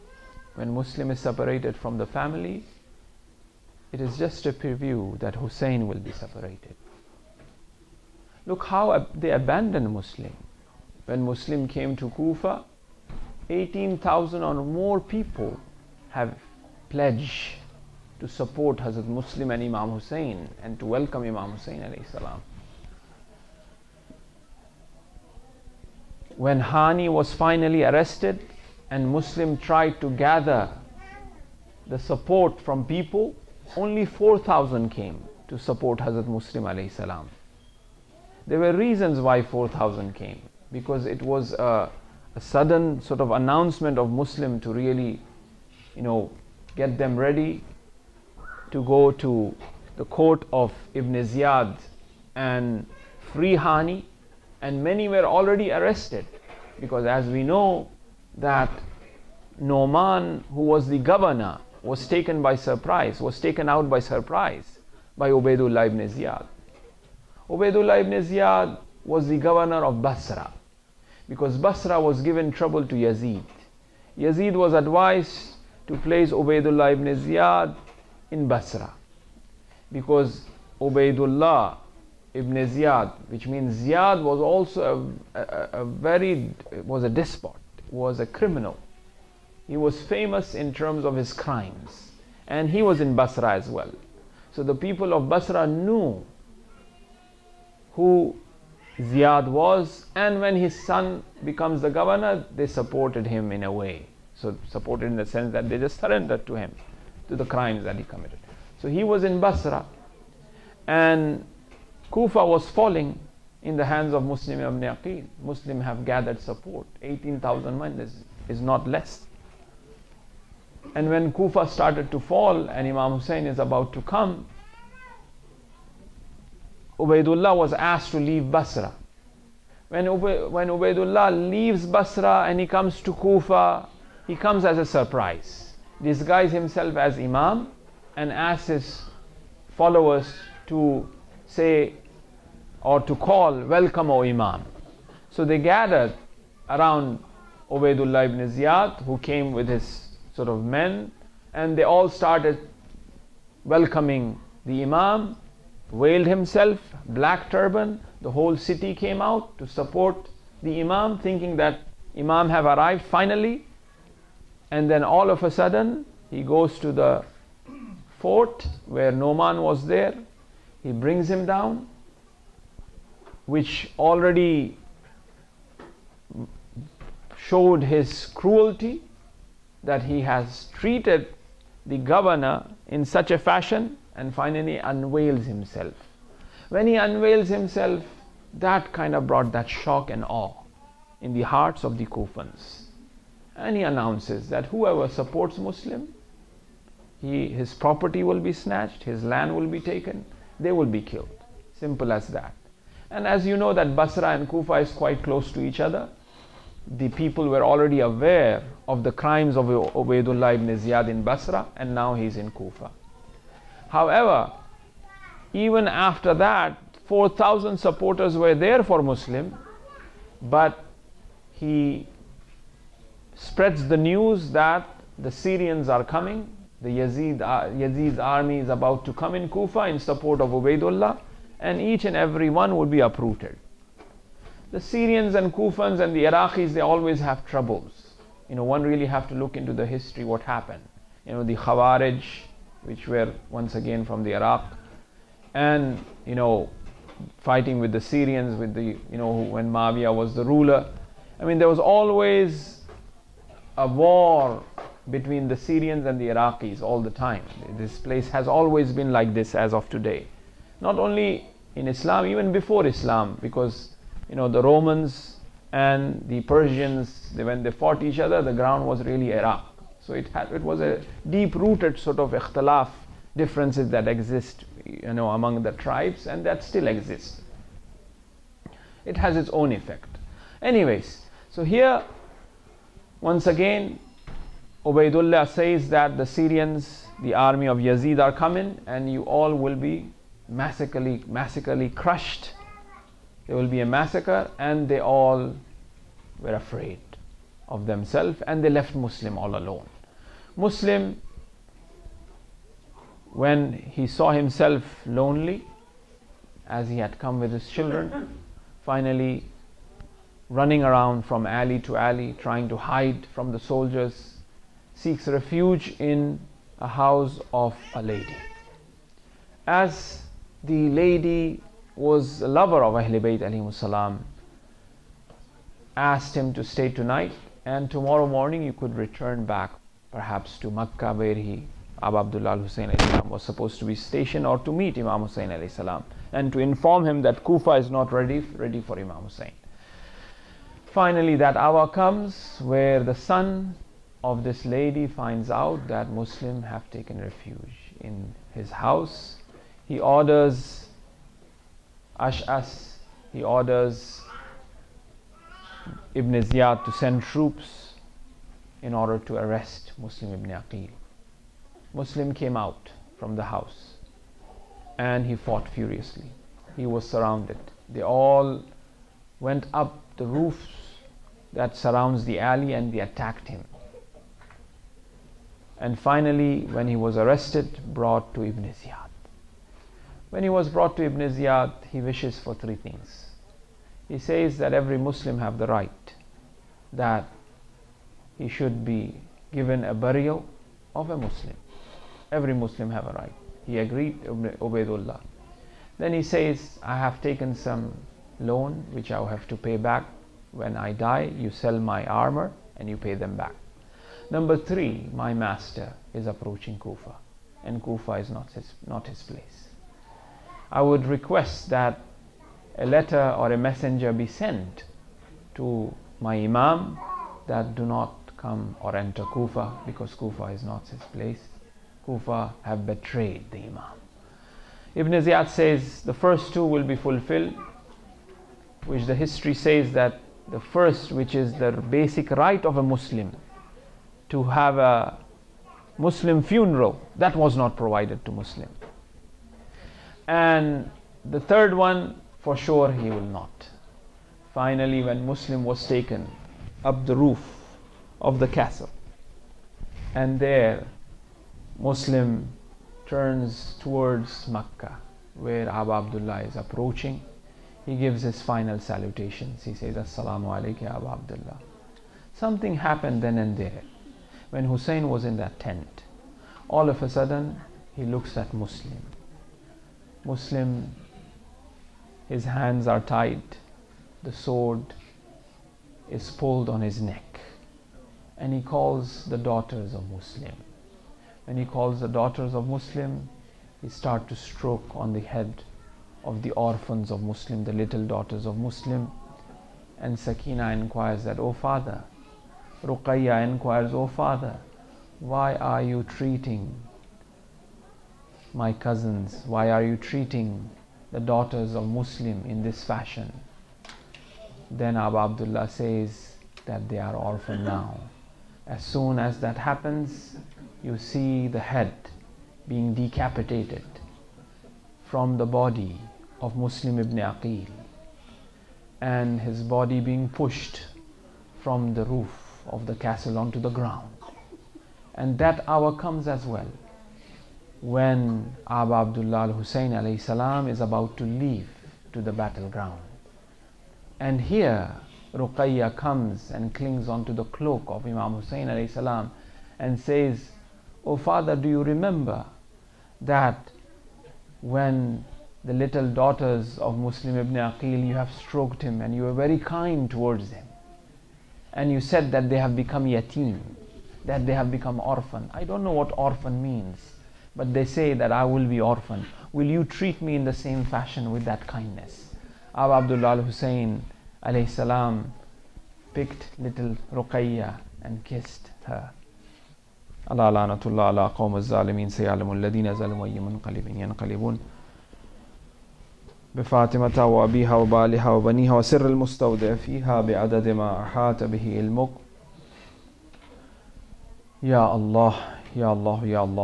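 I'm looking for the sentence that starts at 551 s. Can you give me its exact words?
And you said that they have become yatim, that they have become orphan.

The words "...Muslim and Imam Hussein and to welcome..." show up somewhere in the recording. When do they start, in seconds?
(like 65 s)
19 s.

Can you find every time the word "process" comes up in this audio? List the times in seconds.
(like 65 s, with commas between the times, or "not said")
not said.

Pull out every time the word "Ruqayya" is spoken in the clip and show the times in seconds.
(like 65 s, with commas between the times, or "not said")
492 s, 535 s, 567 s.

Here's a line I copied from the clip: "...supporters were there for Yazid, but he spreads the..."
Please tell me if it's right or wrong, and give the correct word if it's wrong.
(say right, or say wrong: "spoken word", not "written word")
wrong: "Muslim", not "Yazid".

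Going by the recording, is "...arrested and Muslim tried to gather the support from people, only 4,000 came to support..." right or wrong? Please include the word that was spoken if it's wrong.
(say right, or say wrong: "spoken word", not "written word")
right.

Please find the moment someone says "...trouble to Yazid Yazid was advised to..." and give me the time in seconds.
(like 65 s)
72 s.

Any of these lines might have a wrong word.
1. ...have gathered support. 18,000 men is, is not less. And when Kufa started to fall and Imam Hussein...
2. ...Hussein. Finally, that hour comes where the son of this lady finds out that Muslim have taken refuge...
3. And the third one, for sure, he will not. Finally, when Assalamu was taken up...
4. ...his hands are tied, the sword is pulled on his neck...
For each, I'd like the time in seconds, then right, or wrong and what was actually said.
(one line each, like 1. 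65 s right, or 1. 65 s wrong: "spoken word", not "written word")
1. 115 s right
2. 339 s right
3. 440 s wrong: "Muslim", not "Assalamu"
4. 472 s right.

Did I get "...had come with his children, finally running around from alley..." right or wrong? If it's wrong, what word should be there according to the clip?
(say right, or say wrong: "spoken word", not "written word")
right.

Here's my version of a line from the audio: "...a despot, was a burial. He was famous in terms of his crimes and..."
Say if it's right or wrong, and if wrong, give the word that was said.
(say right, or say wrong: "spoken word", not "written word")
wrong: "criminal", not "burial".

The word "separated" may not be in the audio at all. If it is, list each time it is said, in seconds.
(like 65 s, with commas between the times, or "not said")
1 s, 6 s.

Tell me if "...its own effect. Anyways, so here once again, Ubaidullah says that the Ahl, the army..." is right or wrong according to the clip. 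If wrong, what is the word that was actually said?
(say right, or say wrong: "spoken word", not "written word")
wrong: "Syrians", not "Ahl".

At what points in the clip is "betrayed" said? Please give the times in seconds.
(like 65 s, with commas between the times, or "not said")
422 s.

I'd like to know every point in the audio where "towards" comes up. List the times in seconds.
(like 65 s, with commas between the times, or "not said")
453 s, 550 s.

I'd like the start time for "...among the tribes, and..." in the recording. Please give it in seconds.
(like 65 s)
275 s.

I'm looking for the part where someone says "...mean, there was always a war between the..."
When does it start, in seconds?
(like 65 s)
251 s.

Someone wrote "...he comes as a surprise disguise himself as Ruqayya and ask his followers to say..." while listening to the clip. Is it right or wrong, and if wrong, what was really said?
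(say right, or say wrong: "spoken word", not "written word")
wrong: "Imam", not "Ruqayya".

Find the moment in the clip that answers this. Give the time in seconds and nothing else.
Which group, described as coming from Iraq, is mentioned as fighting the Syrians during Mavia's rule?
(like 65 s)
241 s.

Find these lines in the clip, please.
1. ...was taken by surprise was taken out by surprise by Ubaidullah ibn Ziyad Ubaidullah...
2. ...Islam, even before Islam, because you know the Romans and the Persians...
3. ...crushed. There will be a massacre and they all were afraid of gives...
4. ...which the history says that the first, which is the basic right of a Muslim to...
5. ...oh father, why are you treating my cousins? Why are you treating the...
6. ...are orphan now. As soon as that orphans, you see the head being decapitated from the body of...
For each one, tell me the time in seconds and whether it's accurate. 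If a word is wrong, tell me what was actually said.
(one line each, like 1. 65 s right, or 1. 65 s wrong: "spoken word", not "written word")
1. 61 s right
2. 261 s right
3. 291 s wrong: "themselves", not "gives"
4. 428 s right
5. 494 s right
6. 506 s wrong: "happens", not "orphans".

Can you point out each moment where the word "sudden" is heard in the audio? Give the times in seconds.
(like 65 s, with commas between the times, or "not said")
42 s, 165 s, 467 s.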